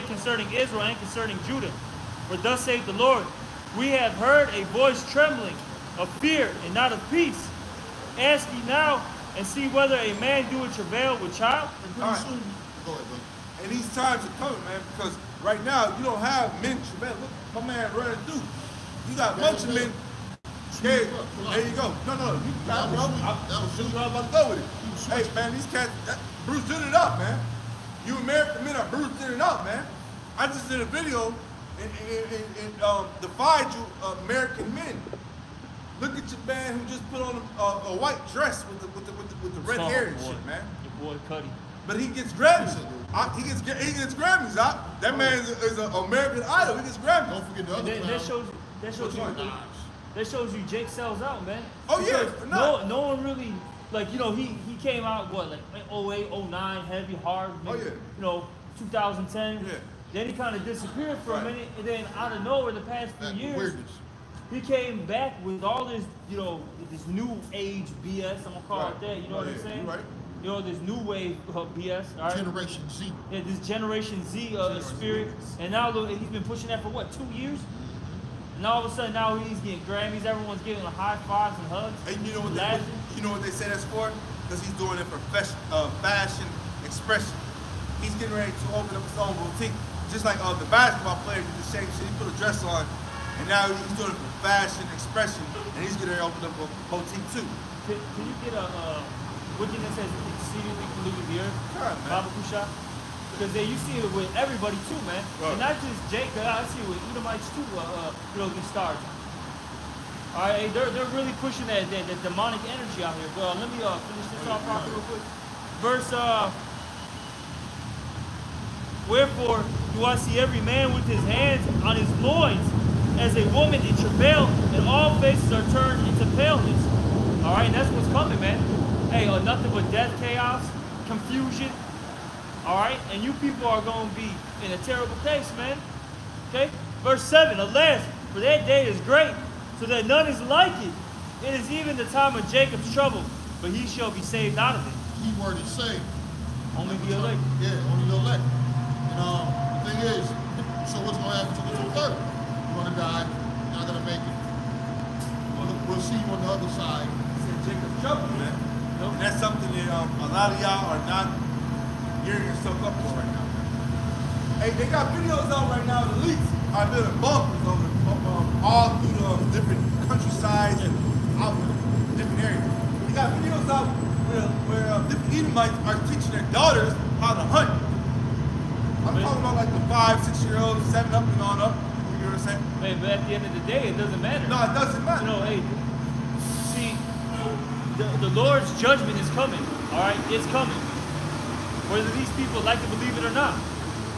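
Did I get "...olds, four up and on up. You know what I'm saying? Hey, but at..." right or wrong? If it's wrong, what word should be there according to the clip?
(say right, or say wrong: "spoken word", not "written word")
wrong: "seven", not "four".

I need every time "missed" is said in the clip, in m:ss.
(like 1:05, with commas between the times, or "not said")
not said.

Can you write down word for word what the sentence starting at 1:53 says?
But uh, let me uh, finish this off real quick.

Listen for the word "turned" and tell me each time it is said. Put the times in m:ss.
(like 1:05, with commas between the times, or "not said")
2:05.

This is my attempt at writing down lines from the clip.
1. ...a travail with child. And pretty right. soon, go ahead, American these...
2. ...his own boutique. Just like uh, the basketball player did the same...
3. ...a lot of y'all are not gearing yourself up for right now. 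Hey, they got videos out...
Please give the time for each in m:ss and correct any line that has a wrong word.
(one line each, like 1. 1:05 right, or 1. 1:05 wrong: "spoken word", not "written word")
1. 0:10 wrong: "And", not "American"
2. 1:29 right
3. 2:40 right.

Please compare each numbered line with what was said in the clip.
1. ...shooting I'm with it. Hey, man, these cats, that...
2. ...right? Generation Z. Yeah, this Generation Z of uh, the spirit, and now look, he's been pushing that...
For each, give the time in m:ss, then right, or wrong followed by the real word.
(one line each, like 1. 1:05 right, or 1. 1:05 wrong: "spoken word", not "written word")
1. 0:23 right
2. 1:12 right.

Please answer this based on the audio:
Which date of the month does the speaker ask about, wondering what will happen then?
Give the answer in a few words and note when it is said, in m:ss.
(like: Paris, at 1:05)
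the 23rd, at 2:31.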